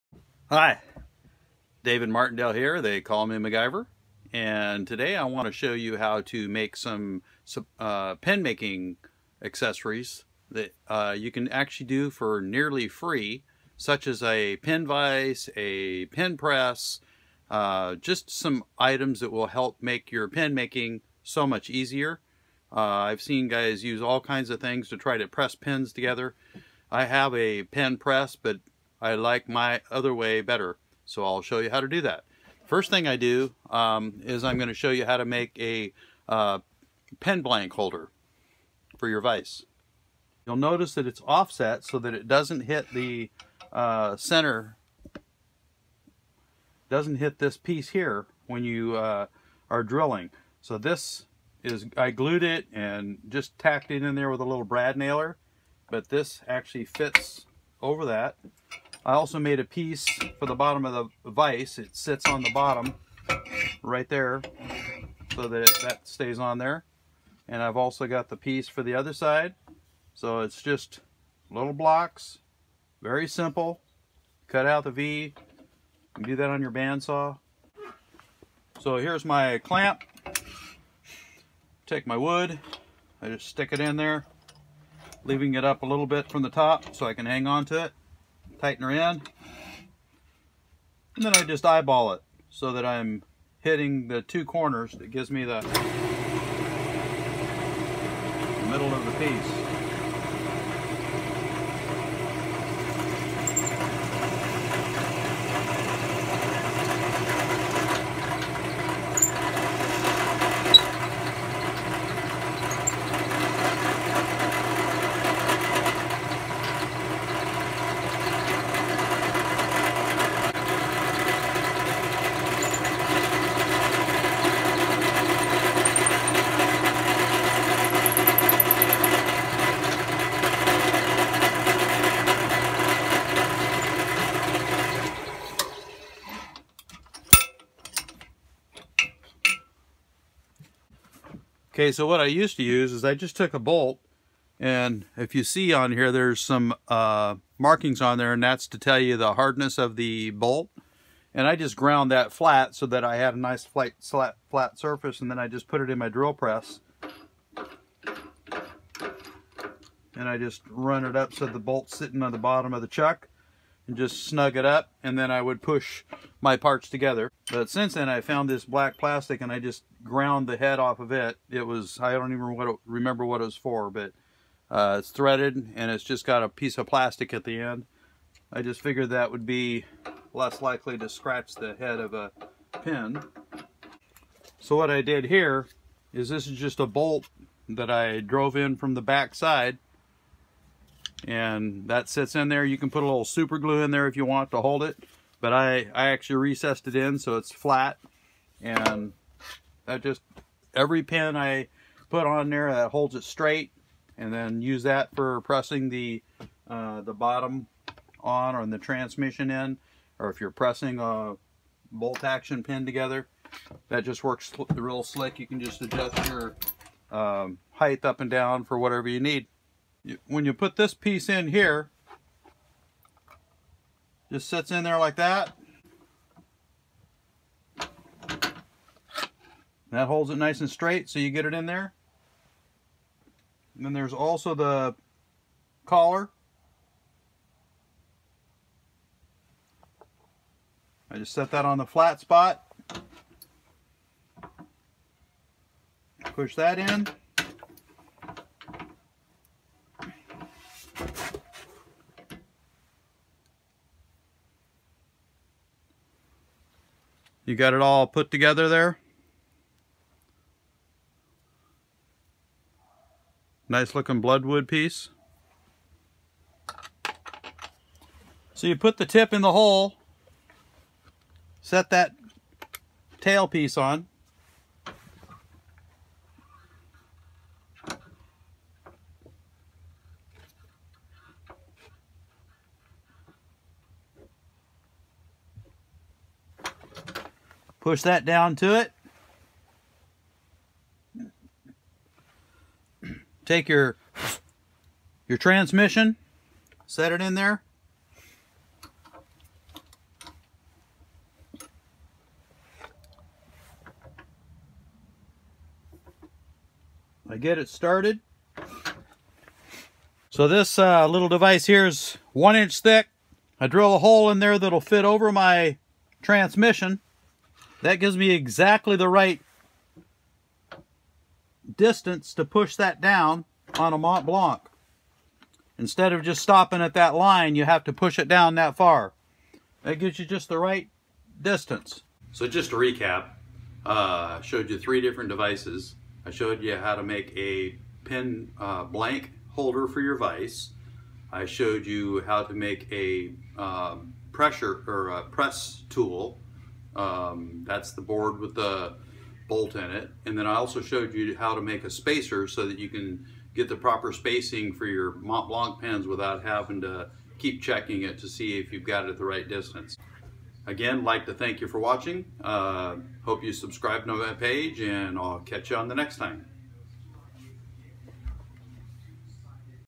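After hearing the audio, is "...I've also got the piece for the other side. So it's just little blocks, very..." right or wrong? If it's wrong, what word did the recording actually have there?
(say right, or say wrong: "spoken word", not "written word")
right.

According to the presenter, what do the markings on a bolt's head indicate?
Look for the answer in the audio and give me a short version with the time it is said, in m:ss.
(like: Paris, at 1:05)
The hardness of the bolt, at 2:29.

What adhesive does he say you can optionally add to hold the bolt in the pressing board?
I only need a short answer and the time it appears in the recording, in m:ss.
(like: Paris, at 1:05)
Super glue, at 3:13.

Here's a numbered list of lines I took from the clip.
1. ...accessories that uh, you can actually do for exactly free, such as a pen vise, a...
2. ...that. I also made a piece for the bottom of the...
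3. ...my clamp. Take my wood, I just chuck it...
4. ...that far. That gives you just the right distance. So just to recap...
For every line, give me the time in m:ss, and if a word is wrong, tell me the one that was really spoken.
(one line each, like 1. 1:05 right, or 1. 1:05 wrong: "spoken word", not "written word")
1. 0:09 wrong: "nearly", not "exactly"
2. 0:58 right
3. 1:19 wrong: "stick", not "chuck"
4. 5:28 right.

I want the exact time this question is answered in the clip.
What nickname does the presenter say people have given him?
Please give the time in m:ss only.
0:03.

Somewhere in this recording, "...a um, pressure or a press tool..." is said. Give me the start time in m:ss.
5:42.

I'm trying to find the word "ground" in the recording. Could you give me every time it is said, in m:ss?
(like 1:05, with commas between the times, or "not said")
2:31, 2:50.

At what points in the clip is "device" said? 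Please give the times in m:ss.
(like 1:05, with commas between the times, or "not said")
5:11, 5:35.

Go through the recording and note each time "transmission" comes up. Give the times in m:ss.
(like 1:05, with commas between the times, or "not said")
3:28, 4:55, 5:16.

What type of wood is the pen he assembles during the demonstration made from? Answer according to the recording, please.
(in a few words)
Bloodwood.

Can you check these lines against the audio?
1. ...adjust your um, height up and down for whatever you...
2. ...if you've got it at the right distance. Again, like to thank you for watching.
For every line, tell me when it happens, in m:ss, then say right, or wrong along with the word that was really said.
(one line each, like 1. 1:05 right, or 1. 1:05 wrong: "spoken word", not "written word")
1. 3:35 right
2. 5:58 right.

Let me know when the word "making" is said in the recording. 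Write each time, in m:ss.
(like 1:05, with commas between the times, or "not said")
0:08, 0:20.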